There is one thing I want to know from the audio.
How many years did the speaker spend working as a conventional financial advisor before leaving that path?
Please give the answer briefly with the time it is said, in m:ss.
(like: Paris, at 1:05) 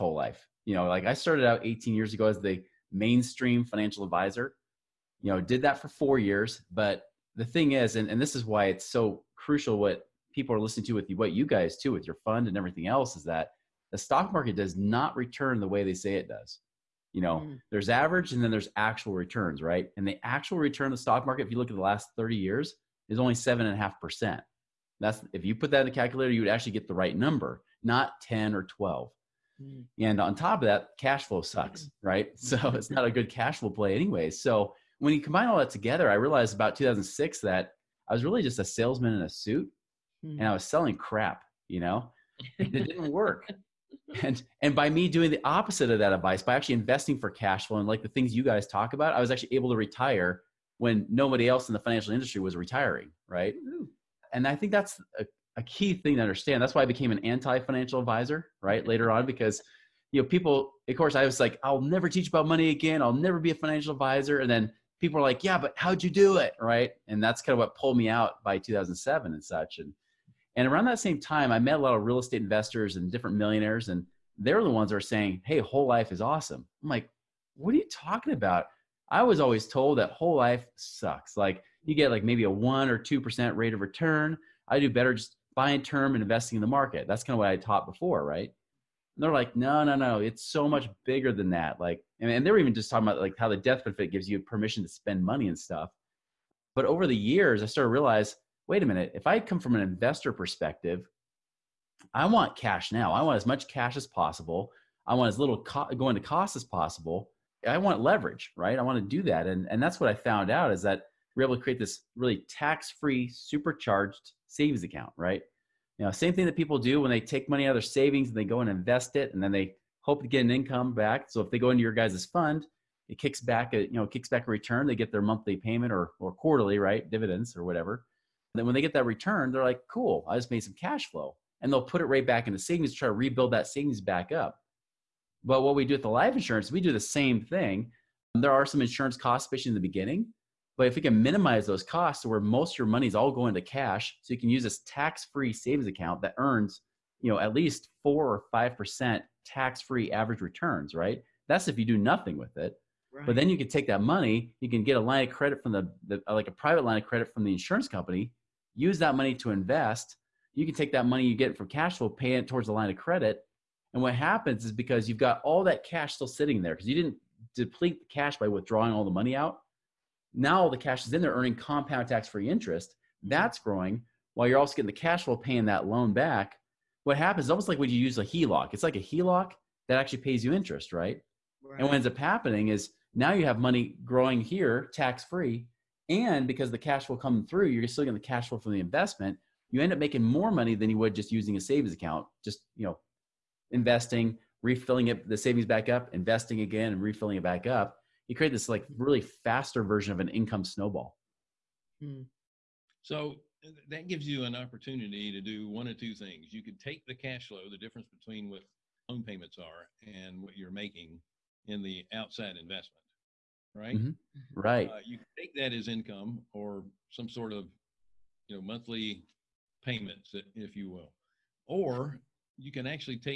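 4, at 0:05.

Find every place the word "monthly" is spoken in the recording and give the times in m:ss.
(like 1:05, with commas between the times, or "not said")
2:05, 3:38.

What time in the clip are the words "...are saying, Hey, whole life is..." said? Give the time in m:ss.
1:14.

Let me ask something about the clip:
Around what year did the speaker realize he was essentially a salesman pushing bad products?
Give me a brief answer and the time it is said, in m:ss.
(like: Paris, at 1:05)
2006, at 0:36.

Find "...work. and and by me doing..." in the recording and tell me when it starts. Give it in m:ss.
0:43.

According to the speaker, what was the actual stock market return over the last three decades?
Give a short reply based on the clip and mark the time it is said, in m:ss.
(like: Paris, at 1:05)
7.5%, at 0:23.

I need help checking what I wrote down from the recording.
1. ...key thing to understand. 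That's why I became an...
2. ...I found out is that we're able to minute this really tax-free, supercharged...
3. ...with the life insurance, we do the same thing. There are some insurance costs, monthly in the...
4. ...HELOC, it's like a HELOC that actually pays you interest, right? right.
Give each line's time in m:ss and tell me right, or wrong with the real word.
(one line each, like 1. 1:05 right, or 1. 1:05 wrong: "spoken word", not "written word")
1. 0:55 right
2. 1:50 wrong: "create", not "minute"
3. 2:15 wrong: "especially", not "monthly"
4. 2:58 right.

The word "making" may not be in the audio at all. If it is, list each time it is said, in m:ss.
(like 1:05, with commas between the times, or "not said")
3:09, 3:30.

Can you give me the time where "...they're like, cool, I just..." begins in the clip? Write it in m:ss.
2:09.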